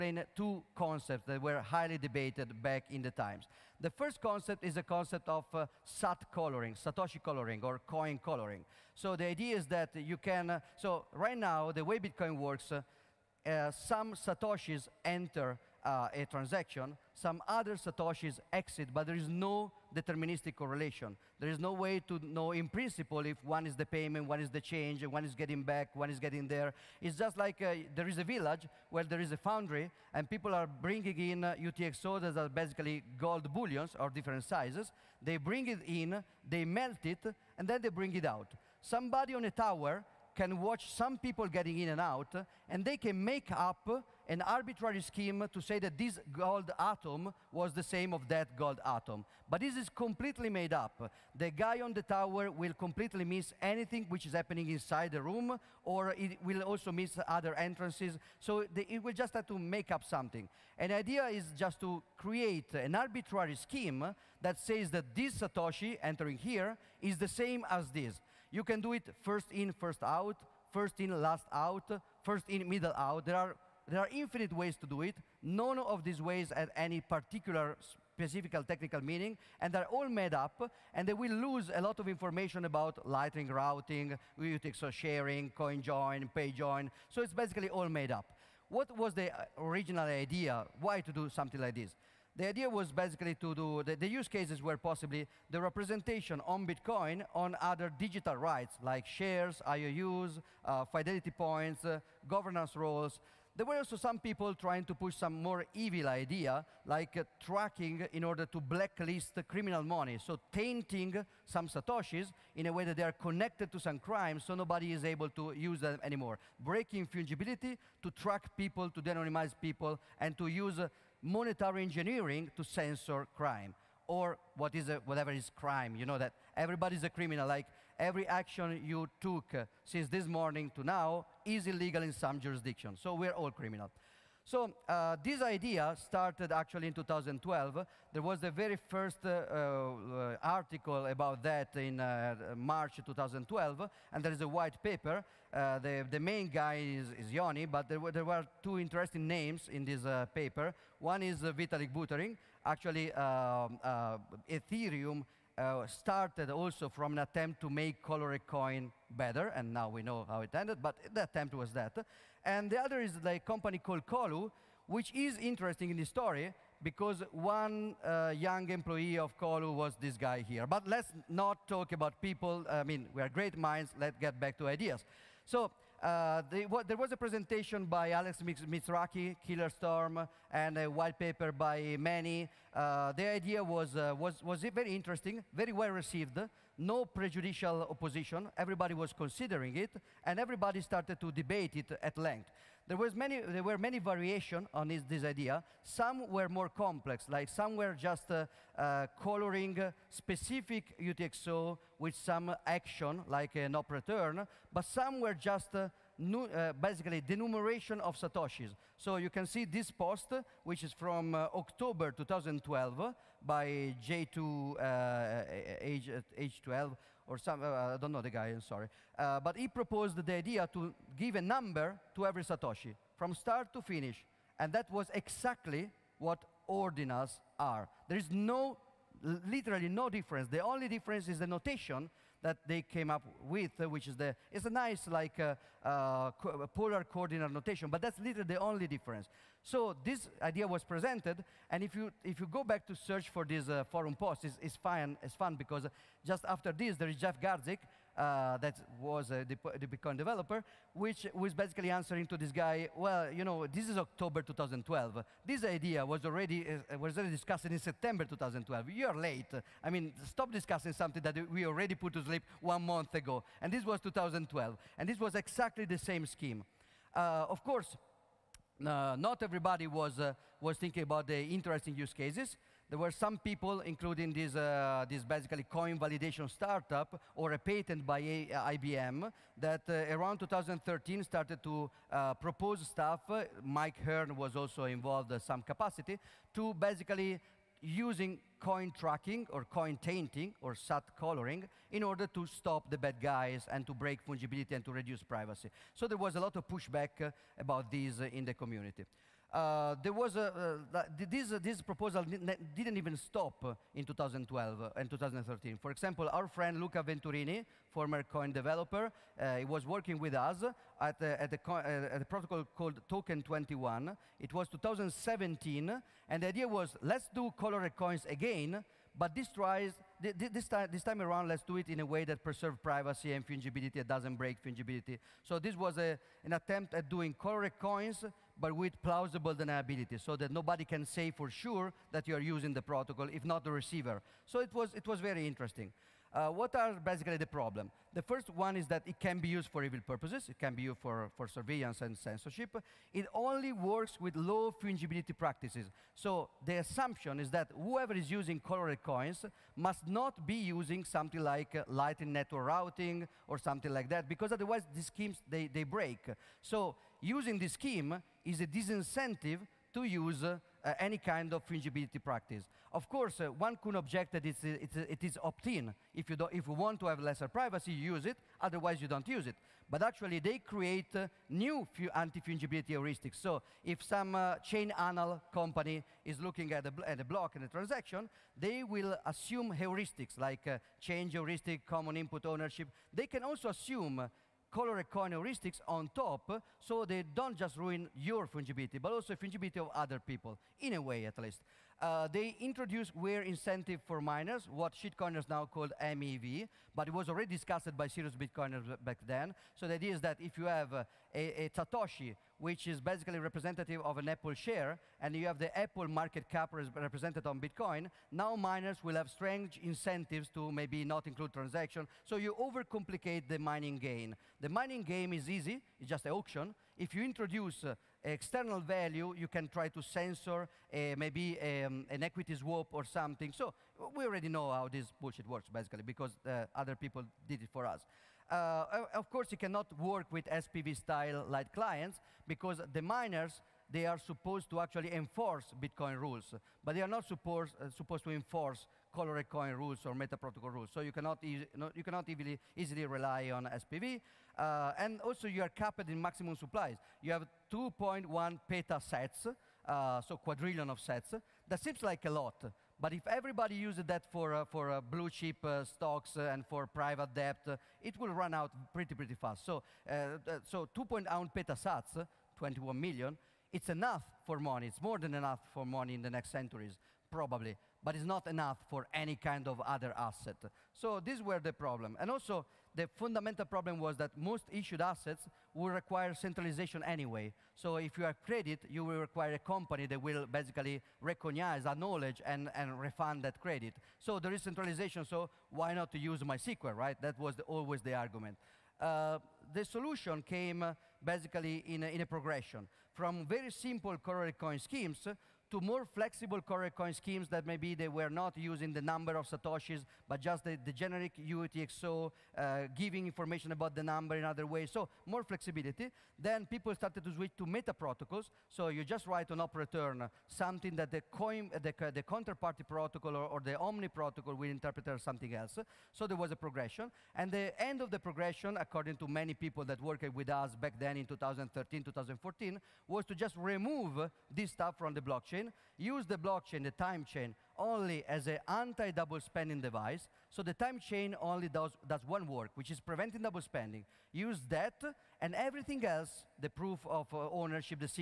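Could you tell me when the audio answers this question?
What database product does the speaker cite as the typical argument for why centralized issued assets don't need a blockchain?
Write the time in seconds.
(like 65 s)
486 s.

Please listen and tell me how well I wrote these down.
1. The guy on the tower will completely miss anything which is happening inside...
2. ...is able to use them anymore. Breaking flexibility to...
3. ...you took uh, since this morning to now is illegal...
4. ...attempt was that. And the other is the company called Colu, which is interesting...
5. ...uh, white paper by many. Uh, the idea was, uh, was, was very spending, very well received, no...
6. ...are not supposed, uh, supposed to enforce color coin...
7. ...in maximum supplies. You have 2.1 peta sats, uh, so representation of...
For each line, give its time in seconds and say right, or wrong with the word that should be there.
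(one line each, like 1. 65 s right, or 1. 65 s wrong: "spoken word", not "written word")
1. 51 s right
2. 114 s wrong: "fungibility", not "flexibility"
3. 128 s right
4. 161 s right
5. 180 s wrong: "interesting", not "spending"
6. 437 s right
7. 446 s wrong: "quadrillion", not "representation".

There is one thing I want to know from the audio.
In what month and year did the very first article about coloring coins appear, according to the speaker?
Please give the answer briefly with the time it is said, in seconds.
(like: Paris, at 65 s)
March 2012, at 142 s.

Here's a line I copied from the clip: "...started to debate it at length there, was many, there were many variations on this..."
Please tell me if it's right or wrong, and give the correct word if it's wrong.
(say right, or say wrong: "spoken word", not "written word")
right.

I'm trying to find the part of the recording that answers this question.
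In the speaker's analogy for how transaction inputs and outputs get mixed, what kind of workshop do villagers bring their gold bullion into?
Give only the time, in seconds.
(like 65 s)
29 s.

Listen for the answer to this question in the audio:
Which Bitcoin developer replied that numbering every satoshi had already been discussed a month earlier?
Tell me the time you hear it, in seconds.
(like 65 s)
247 s.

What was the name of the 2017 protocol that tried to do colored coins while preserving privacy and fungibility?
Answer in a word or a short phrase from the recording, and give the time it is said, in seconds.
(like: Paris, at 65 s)
Token 21, at 313 s.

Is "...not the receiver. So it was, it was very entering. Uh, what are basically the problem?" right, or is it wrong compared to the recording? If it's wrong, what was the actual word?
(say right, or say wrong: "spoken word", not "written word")
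wrong: "interesting", not "entering".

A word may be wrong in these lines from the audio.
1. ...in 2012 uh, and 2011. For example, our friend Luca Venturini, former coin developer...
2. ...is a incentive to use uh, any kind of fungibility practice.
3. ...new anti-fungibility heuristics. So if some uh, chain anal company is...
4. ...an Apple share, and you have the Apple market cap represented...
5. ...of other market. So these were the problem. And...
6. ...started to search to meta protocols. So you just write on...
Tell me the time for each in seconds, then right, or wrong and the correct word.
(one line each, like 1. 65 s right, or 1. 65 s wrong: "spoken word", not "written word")
1. 303 s wrong: "2013", not "2011"
2. 358 s wrong: "disincentive", not "incentive"
3. 371 s right
4. 404 s right
5. 469 s wrong: "asset", not "market"
6. 506 s wrong: "switch", not "search".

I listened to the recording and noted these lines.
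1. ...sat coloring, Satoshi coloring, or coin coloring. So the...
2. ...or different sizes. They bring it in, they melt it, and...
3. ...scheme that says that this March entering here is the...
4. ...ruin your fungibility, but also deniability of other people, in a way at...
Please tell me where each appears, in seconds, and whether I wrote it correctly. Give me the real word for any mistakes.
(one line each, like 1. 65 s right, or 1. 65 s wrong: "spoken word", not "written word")
1. 5 s right
2. 33 s right
3. 63 s wrong: "Satoshi", not "March"
4. 387 s wrong: "fungibility", not "deniability".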